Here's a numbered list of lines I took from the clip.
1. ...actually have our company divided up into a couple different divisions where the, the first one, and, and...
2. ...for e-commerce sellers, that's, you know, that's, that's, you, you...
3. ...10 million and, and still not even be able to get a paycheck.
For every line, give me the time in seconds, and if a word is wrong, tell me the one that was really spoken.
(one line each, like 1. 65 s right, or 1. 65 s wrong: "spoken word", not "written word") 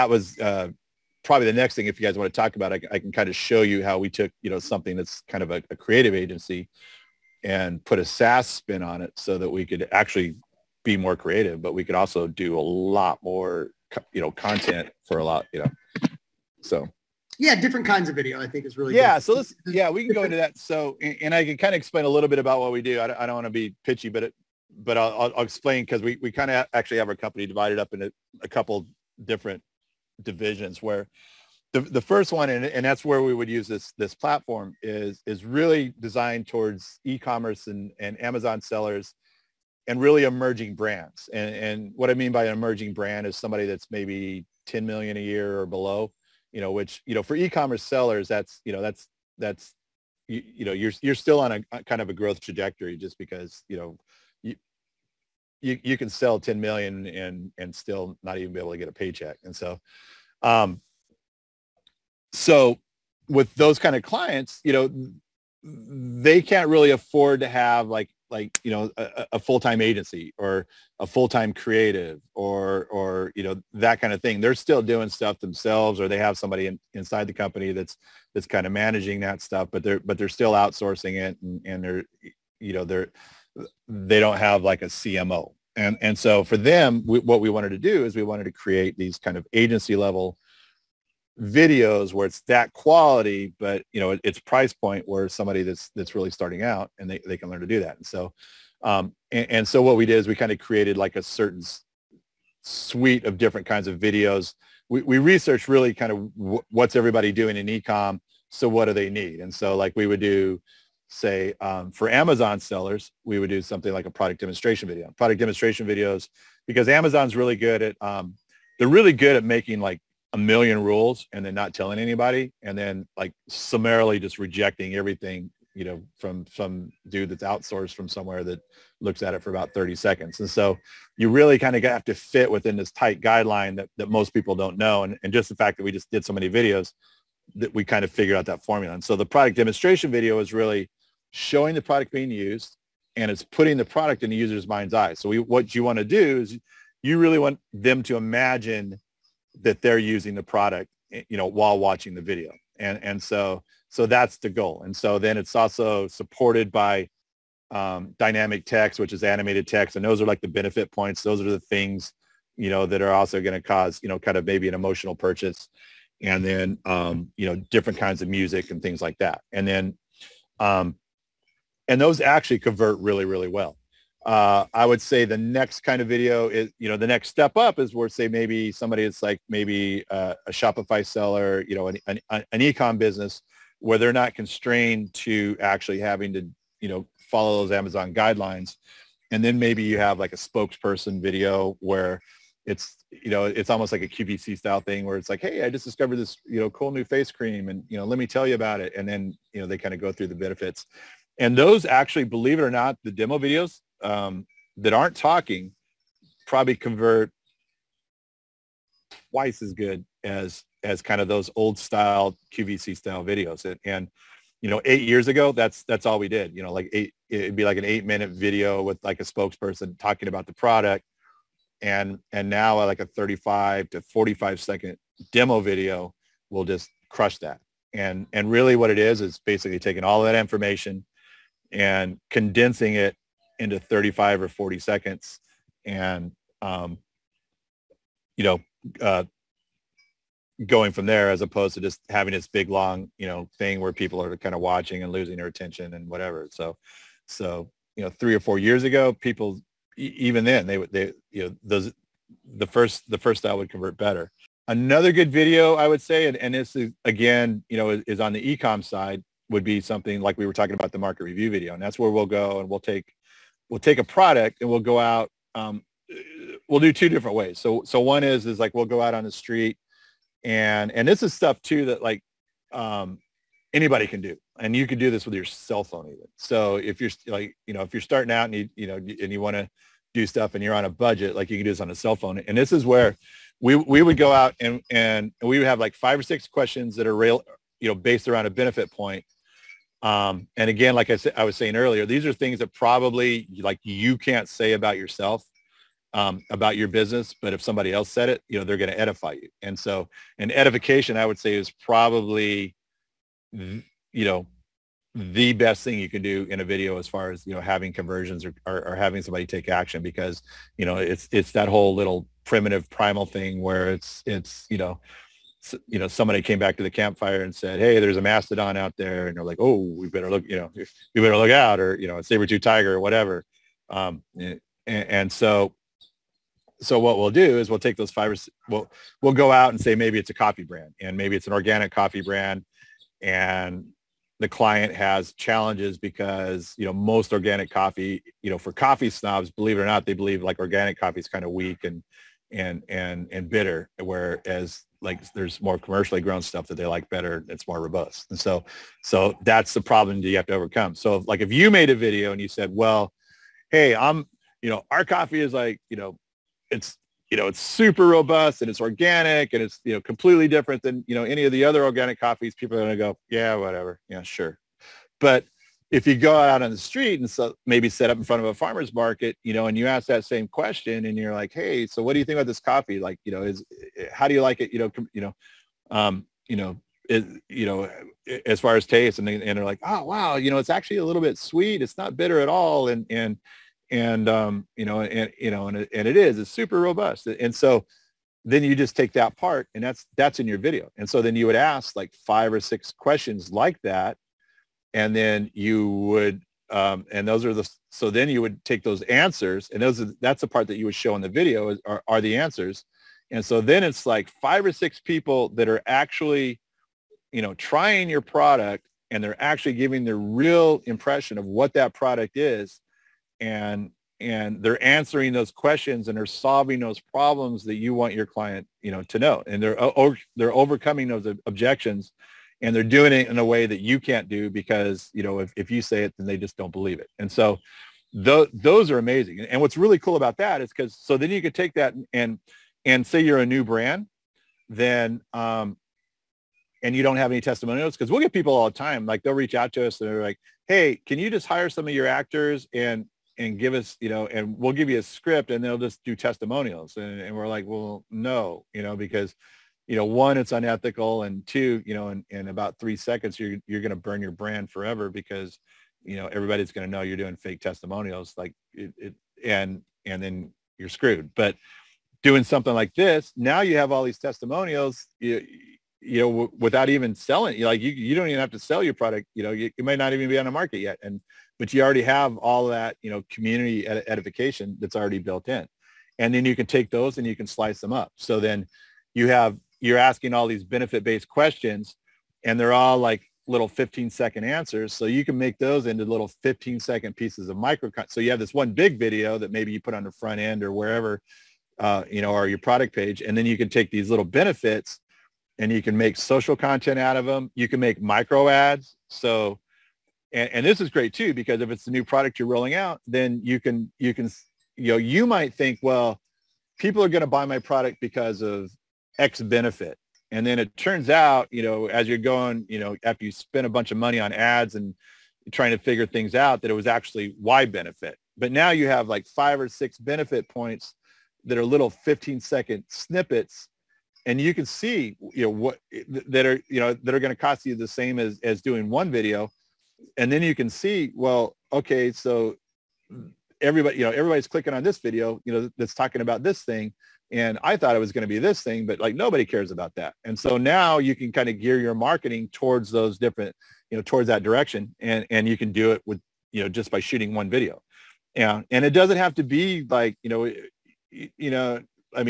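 1. 26 s right
2. 47 s right
3. 56 s right.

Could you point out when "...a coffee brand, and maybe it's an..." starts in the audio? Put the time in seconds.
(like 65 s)
330 s.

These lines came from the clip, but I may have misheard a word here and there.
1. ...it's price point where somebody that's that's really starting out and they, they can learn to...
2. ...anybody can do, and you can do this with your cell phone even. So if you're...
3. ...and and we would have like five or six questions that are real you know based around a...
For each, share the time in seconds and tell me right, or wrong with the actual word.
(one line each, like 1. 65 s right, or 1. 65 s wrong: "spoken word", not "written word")
1. 94 s right
2. 273 s right
3. 284 s right.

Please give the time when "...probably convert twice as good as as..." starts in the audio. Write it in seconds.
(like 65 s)
206 s.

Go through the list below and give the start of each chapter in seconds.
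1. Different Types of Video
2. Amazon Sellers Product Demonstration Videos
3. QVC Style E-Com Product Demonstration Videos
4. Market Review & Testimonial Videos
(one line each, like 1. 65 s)
1. 17 s
2. 109 s
3. 174 s
4. 254 s.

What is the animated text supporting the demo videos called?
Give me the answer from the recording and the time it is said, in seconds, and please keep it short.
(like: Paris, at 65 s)
Dynamic text, at 158 s.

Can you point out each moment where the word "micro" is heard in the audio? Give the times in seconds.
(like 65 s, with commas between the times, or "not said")
487 s, 498 s.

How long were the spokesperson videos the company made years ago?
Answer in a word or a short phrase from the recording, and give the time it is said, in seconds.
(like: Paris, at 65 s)
8 minutes, at 217 s.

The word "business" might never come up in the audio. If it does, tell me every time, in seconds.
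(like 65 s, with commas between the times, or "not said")
182 s, 296 s.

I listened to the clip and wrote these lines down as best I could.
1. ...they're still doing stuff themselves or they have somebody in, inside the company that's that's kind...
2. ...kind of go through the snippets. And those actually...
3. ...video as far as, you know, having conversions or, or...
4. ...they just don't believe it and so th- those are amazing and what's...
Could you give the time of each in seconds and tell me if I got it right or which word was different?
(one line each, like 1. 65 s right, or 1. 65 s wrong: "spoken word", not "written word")
1. 74 s right
2. 199 s wrong: "benefits", not "snippets"
3. 306 s right
4. 426 s right.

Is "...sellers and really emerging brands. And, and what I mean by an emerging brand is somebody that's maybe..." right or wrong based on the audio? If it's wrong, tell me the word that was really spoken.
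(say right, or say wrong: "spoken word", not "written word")
right.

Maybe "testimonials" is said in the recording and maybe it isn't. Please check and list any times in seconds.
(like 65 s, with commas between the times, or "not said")
437 s, 446 s, 457 s, 464 s.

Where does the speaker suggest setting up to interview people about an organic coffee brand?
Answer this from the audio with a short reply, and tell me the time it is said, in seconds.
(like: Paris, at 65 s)
Farmer's market, at 368 s.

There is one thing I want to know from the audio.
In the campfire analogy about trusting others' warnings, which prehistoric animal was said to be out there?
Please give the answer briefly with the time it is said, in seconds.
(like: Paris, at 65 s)
Mastodon, at 318 s.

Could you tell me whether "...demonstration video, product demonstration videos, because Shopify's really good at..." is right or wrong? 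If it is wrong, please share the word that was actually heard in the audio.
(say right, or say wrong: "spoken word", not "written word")
wrong: "Amazon", not "Shopify".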